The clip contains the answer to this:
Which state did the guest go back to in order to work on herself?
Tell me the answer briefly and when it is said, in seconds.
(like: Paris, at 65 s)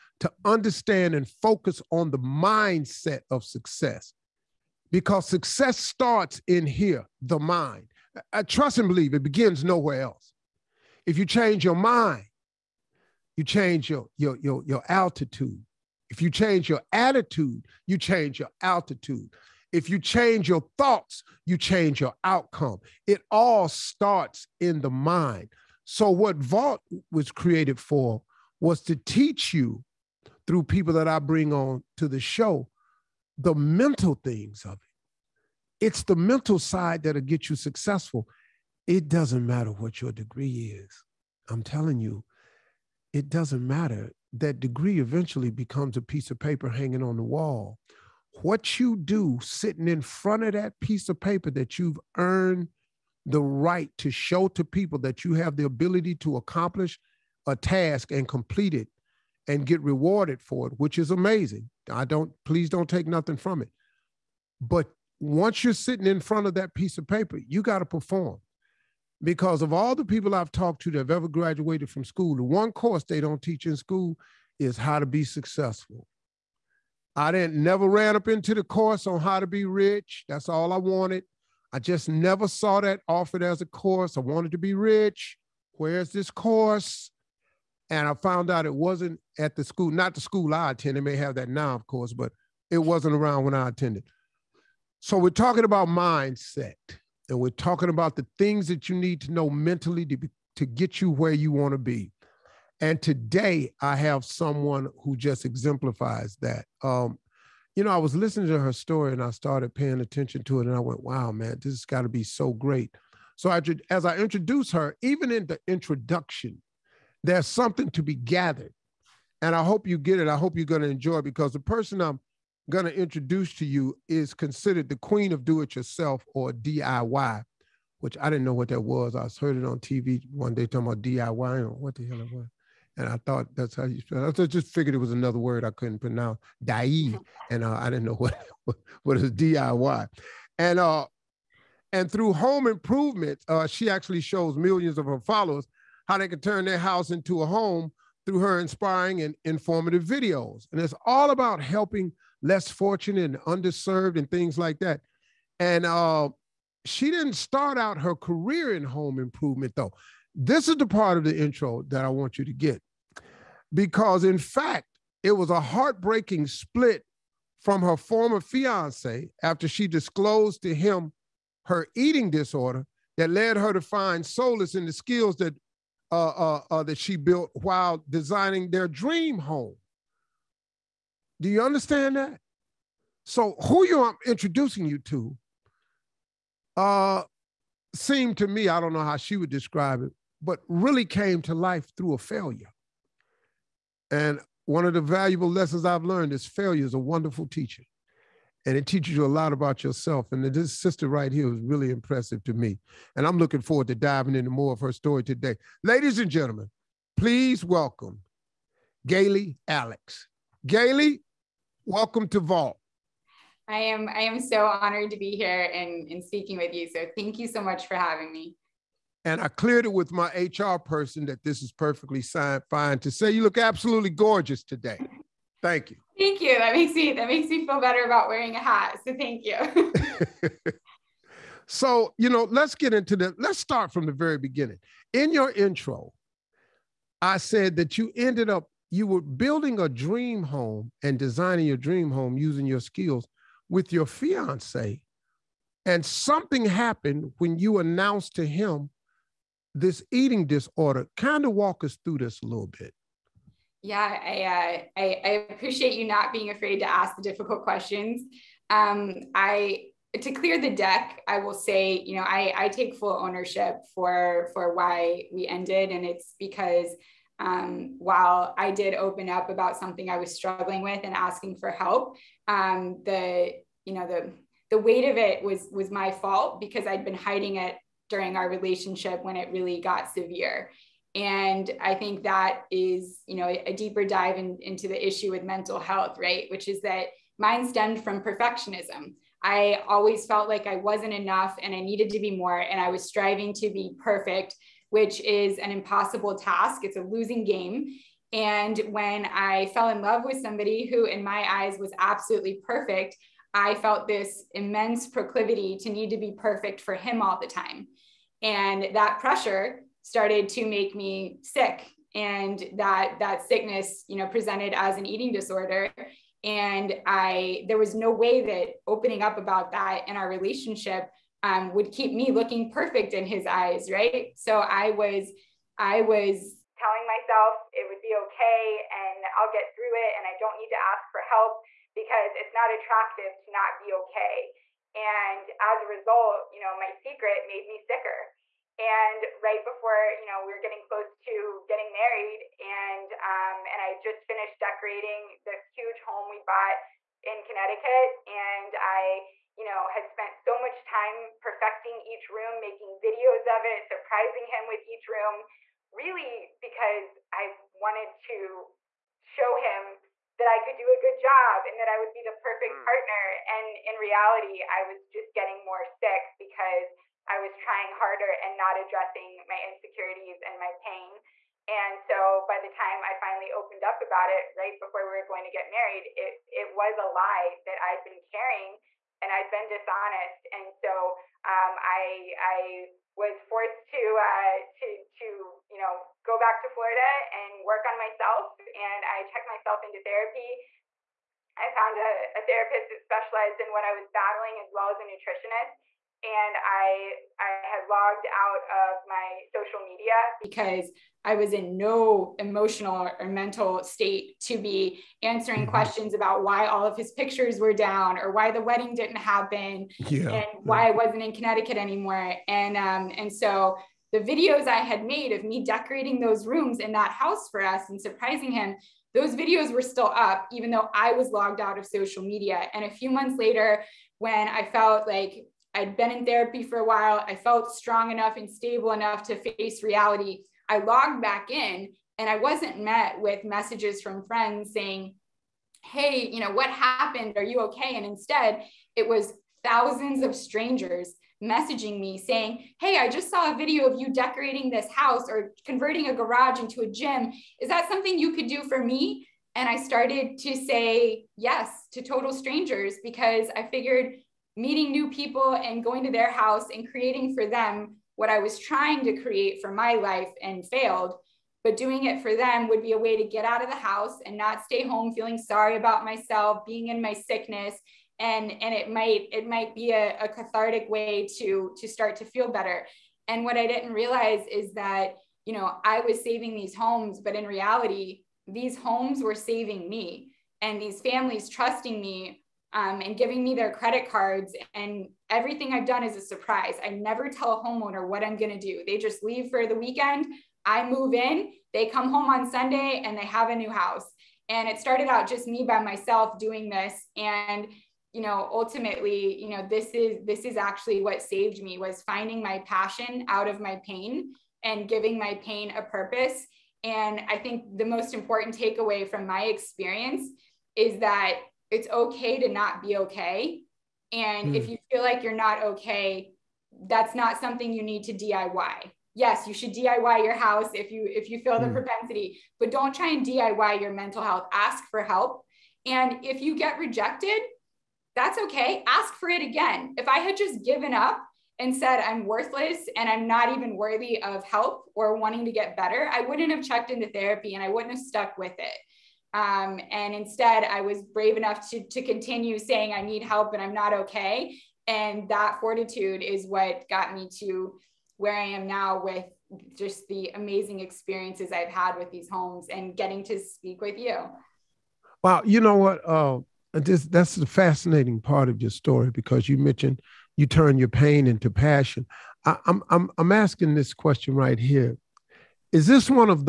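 Florida, at 386 s.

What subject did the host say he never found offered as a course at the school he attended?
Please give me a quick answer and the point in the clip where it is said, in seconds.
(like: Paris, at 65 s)
How to be rich, at 78 s.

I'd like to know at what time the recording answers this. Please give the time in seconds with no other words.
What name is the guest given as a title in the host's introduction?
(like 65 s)
124 s.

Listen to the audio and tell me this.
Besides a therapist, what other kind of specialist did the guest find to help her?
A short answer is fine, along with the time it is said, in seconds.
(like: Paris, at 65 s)
A nutritionist, at 394 s.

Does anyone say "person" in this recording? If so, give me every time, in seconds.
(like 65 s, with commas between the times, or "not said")
121 s, 220 s.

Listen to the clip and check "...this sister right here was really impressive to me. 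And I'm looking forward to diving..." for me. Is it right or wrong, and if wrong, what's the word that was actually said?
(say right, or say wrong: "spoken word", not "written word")
right.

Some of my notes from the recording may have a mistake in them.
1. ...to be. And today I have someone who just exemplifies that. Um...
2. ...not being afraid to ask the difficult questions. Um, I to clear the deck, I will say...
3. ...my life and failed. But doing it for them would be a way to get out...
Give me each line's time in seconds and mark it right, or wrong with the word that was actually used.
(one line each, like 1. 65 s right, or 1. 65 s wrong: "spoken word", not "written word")
1. 101 s right
2. 256 s right
3. 459 s right.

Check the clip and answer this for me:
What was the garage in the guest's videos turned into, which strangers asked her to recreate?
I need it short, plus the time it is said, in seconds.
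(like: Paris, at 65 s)
A gym, at 446 s.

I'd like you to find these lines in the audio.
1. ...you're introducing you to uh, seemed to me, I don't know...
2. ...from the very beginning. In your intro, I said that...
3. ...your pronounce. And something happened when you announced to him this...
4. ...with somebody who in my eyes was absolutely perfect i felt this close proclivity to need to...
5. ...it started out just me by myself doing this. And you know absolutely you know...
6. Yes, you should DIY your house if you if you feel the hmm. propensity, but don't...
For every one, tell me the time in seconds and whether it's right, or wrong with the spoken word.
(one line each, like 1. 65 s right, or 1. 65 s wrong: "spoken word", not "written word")
1. 183 s right
2. 233 s right
3. 243 s wrong: "fiance", not "pronounce"
4. 300 s wrong: "immense", not "close"
5. 494 s wrong: "ultimately", not "absolutely"
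6. 519 s right.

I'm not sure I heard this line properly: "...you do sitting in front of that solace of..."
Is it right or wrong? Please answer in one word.
wrong.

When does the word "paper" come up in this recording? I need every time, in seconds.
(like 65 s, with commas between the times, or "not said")
46 s, 51 s, 67 s.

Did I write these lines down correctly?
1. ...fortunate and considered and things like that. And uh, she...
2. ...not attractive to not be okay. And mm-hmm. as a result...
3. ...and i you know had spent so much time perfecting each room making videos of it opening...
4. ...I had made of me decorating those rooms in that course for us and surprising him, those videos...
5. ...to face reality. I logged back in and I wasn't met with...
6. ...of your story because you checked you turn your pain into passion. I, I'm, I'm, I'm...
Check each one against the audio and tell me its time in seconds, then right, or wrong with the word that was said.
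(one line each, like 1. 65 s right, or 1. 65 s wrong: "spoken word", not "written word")
1. 152 s wrong: "underserved", not "considered"
2. 332 s right
3. 348 s wrong: "surprising", not "opening"
4. 414 s wrong: "house", not "course"
5. 429 s right
6. 558 s wrong: "mentioned", not "checked".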